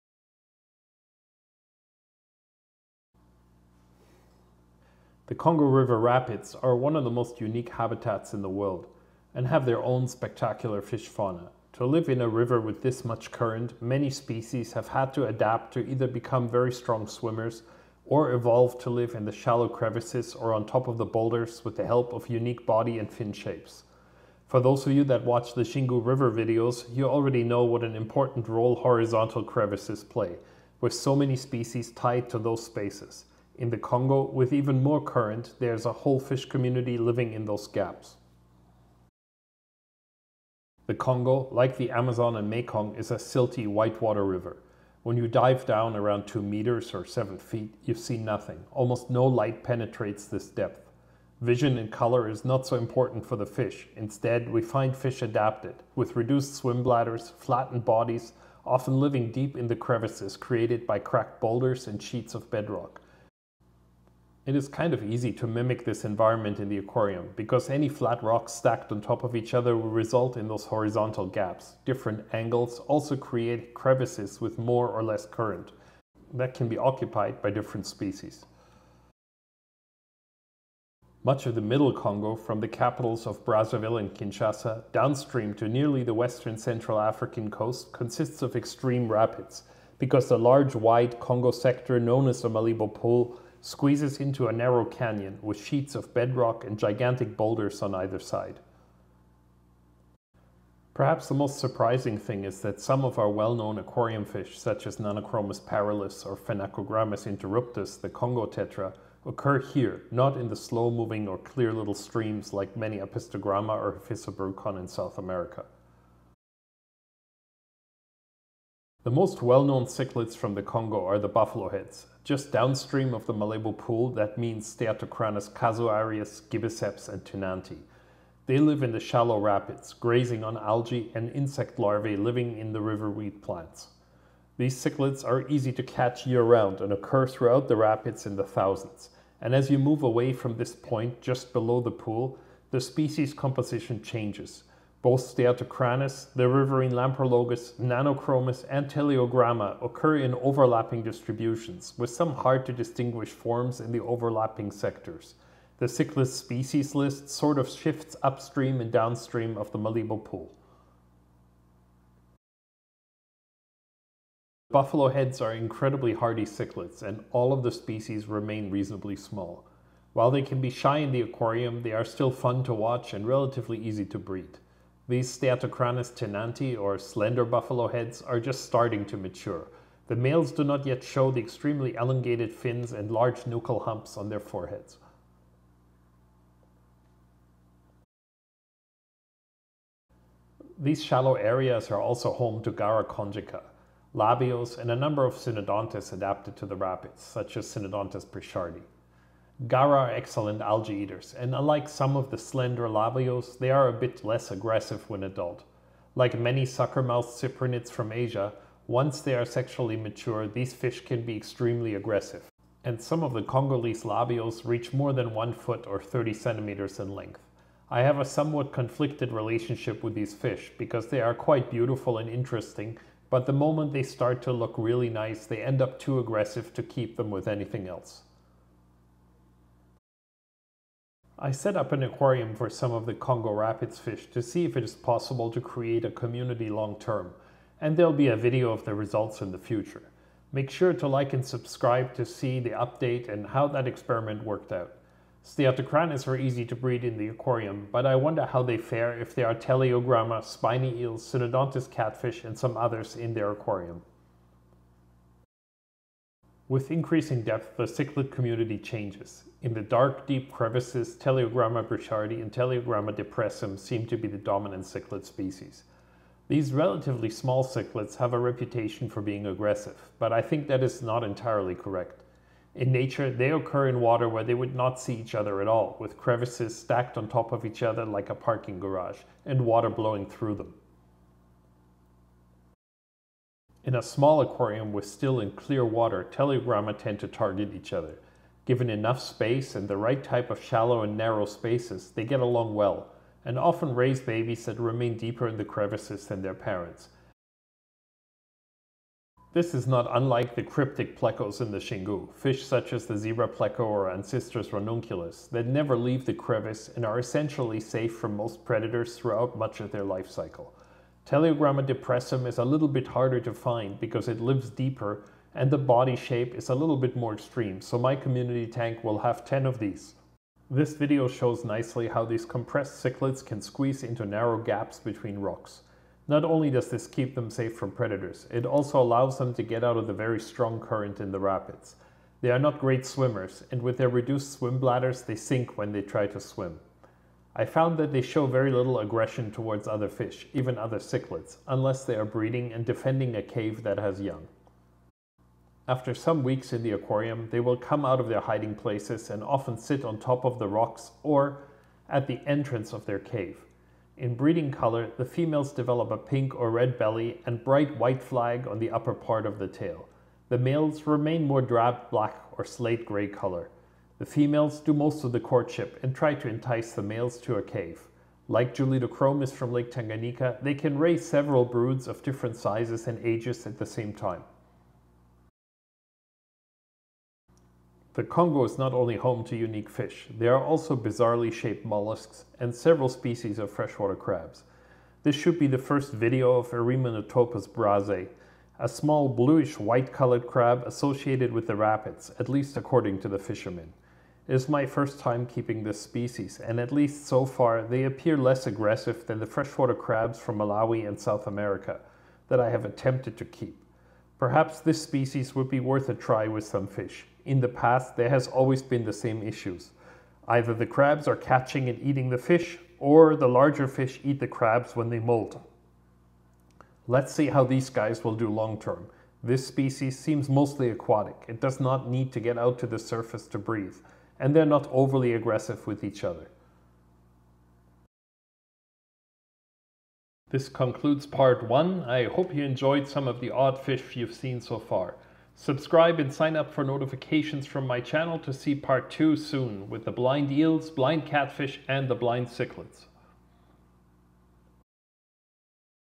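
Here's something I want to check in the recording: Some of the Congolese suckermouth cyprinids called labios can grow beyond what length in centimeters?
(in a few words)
30 centimeters.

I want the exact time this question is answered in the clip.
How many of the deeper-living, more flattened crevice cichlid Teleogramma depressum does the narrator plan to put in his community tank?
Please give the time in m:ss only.
5:19.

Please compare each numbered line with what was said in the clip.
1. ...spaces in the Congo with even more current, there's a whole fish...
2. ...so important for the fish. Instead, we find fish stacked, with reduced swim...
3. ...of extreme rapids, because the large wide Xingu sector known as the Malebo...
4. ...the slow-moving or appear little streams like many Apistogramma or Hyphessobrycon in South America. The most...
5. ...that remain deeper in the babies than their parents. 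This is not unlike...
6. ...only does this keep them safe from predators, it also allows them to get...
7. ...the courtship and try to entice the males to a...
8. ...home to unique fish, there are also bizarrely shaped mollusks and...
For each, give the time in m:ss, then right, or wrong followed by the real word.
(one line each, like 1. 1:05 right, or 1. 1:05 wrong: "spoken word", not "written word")
1. 0:32 right
2. 0:52 wrong: "adapted", not "stacked"
3. 1:28 wrong: "Congo", not "Xingu"
4. 1:50 wrong: "clear", not "appear"
5. 4:54 wrong: "crevices", not "babies"
6. 5:26 right
7. 6:05 right
8. 6:19 right.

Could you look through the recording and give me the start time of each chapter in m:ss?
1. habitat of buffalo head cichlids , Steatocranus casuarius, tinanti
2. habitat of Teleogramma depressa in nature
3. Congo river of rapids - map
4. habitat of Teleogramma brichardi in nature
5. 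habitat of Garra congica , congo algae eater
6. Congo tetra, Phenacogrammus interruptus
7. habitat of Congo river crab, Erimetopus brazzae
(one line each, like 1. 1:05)
1. 1:59
2. 4:44
3. 1:20
4. 3:50
5. 3:09
6. 1:38
7. 6:17.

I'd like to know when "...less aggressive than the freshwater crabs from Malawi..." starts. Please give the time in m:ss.
6:38.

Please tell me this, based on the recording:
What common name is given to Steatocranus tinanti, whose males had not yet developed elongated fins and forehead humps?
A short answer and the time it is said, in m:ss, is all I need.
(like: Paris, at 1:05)
slender buffalo heads, at 2:56.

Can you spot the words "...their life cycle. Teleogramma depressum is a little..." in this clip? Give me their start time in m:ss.
5:09.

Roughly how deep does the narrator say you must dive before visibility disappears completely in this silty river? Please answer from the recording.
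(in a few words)
2 meters.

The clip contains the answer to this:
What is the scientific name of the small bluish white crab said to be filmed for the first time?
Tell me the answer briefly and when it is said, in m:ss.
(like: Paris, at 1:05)
Erimetopus brazzae, at 6:26.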